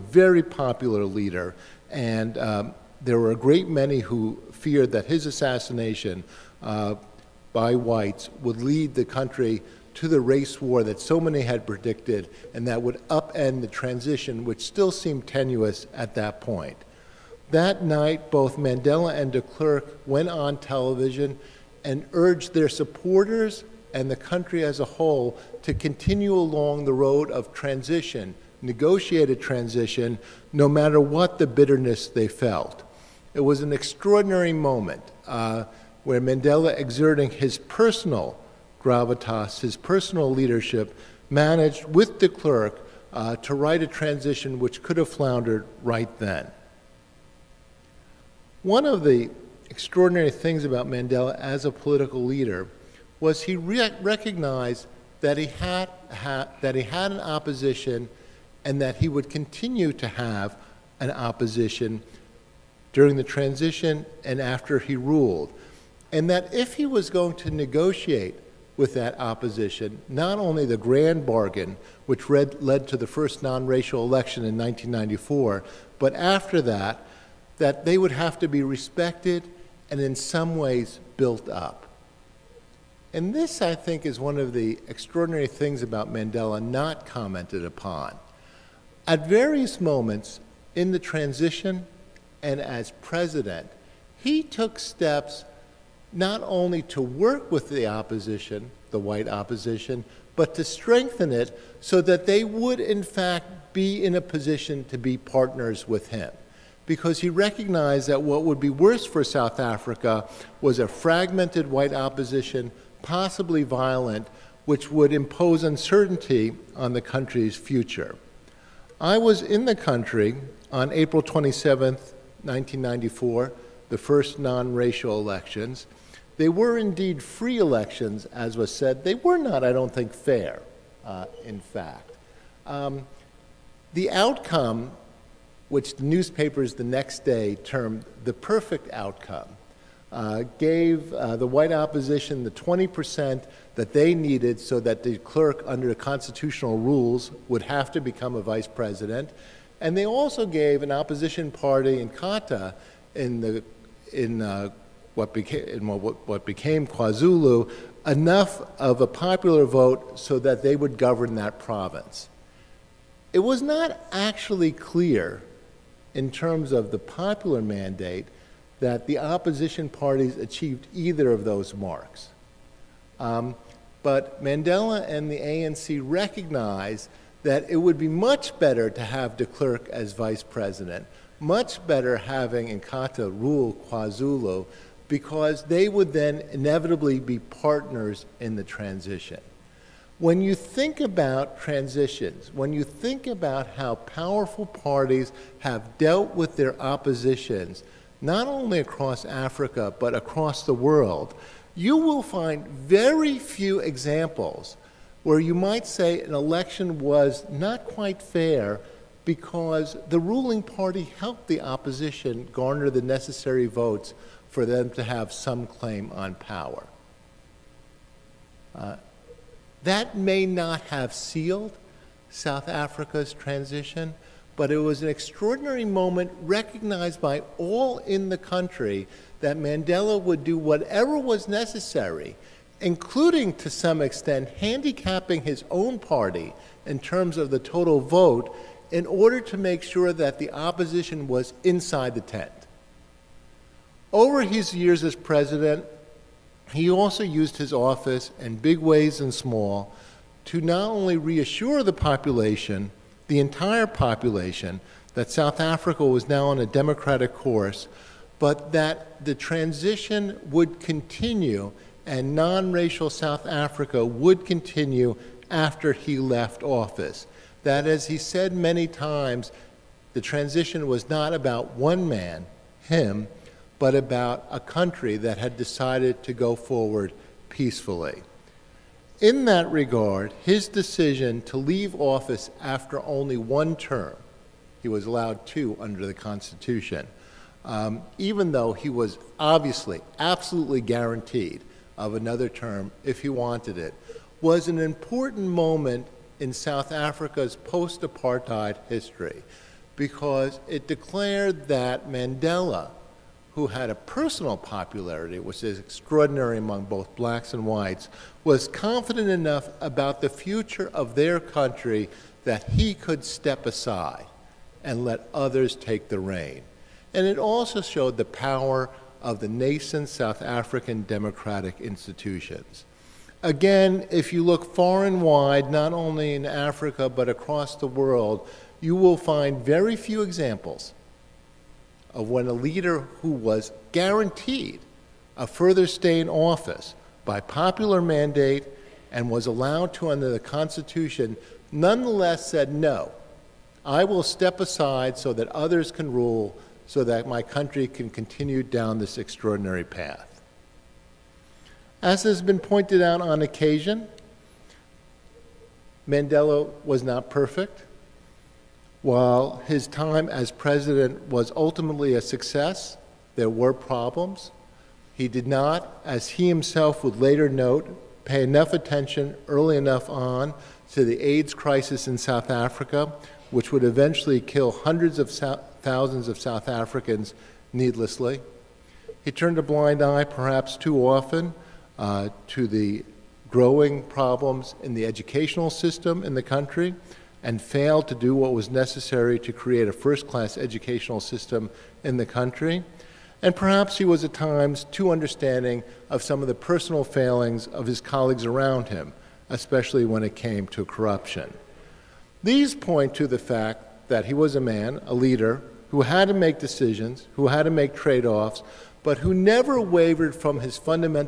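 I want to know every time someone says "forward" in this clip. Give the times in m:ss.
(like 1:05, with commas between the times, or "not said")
4:36.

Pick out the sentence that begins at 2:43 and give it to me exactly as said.
It was not actually clear in terms of the popular mandate that the opposition parties achieved either of those marks.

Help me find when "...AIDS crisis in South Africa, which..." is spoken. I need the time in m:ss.
6:11.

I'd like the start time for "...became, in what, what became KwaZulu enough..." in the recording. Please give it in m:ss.
2:35.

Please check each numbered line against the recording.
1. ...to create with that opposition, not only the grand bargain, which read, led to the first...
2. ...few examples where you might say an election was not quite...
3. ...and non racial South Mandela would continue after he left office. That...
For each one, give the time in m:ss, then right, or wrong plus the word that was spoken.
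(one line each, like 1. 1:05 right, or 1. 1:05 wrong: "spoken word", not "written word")
1. 1:07 wrong: "negotiate", not "create"
2. 3:23 right
3. 4:22 wrong: "Africa", not "Mandela".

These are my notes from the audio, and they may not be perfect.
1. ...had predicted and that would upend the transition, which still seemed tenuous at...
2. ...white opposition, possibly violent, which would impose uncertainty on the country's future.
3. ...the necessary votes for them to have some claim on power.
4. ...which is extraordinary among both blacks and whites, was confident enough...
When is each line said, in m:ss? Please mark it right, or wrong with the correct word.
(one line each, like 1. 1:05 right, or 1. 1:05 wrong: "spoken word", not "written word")
1. 0:11 right
2. 1:51 right
3. 3:32 right
4. 5:05 right.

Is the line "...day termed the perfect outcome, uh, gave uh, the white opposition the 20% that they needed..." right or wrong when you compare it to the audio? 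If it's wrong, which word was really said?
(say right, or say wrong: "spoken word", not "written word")
right.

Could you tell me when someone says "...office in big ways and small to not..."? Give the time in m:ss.
4:07.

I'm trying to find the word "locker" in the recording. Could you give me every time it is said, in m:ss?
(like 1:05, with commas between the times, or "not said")
not said.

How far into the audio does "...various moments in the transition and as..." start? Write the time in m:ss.
1:29.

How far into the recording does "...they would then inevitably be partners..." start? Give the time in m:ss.
3:05.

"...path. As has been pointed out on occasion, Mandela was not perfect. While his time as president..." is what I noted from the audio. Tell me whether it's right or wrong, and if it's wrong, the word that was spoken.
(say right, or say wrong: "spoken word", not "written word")
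right.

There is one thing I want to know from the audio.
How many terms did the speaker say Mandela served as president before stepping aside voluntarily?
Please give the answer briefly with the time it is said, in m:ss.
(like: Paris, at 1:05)
1, at 4:43.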